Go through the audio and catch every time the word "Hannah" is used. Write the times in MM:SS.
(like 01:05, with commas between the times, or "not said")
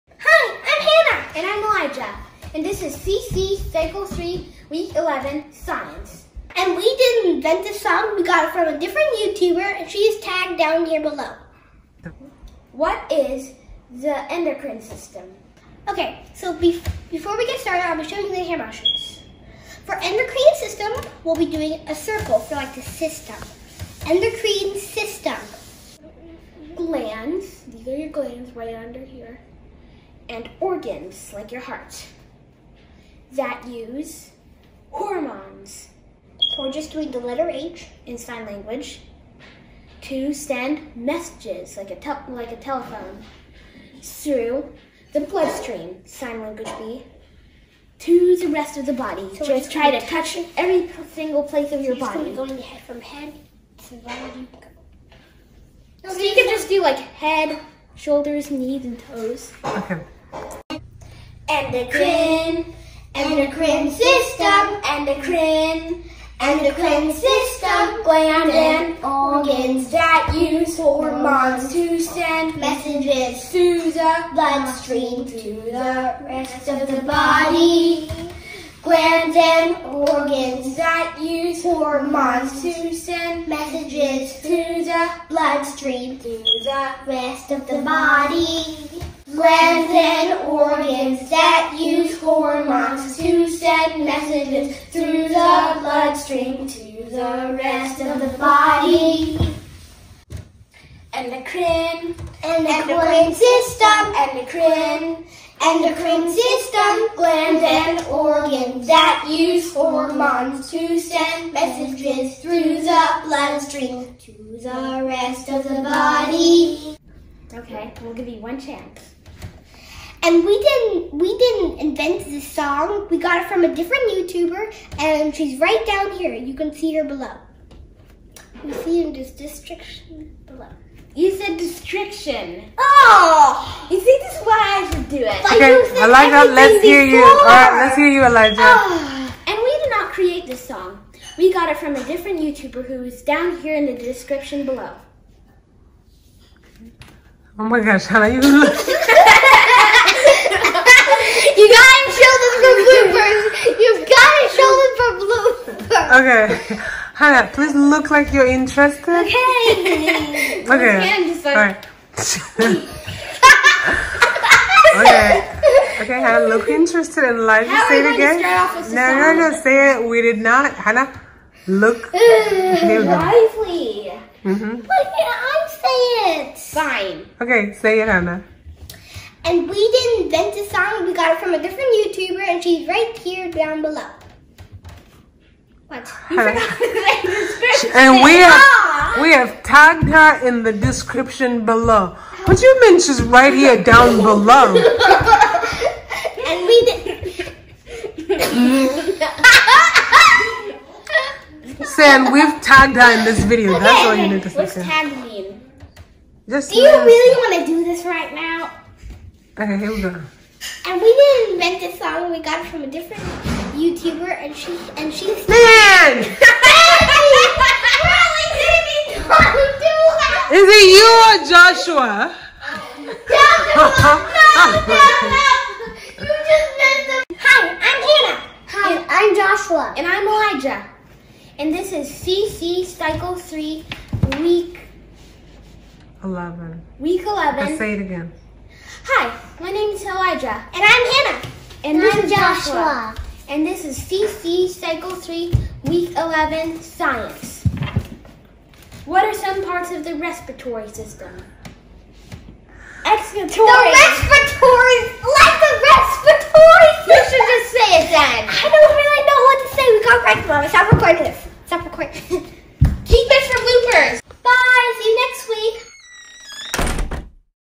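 02:28, 02:37, 02:46, 02:50, 02:58, 03:06, 03:48, 04:01.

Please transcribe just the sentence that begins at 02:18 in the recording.
Uh, and we did not create this song.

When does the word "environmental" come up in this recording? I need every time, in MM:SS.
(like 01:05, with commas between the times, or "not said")
not said.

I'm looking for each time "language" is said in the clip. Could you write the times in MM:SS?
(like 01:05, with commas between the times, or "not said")
00:38, 00:46.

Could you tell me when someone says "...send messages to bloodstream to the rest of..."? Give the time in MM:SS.
01:22.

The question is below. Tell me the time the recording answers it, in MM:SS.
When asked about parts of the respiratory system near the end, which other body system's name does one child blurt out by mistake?
04:13.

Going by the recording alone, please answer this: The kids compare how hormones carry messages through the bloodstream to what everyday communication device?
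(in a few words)
Telephone.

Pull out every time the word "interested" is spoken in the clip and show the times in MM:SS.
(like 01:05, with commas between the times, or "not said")
02:38, 02:46.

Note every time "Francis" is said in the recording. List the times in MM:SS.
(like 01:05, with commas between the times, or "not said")
not said.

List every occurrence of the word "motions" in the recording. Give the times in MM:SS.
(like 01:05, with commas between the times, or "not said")
00:18.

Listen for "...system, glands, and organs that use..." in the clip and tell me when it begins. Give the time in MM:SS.
01:46.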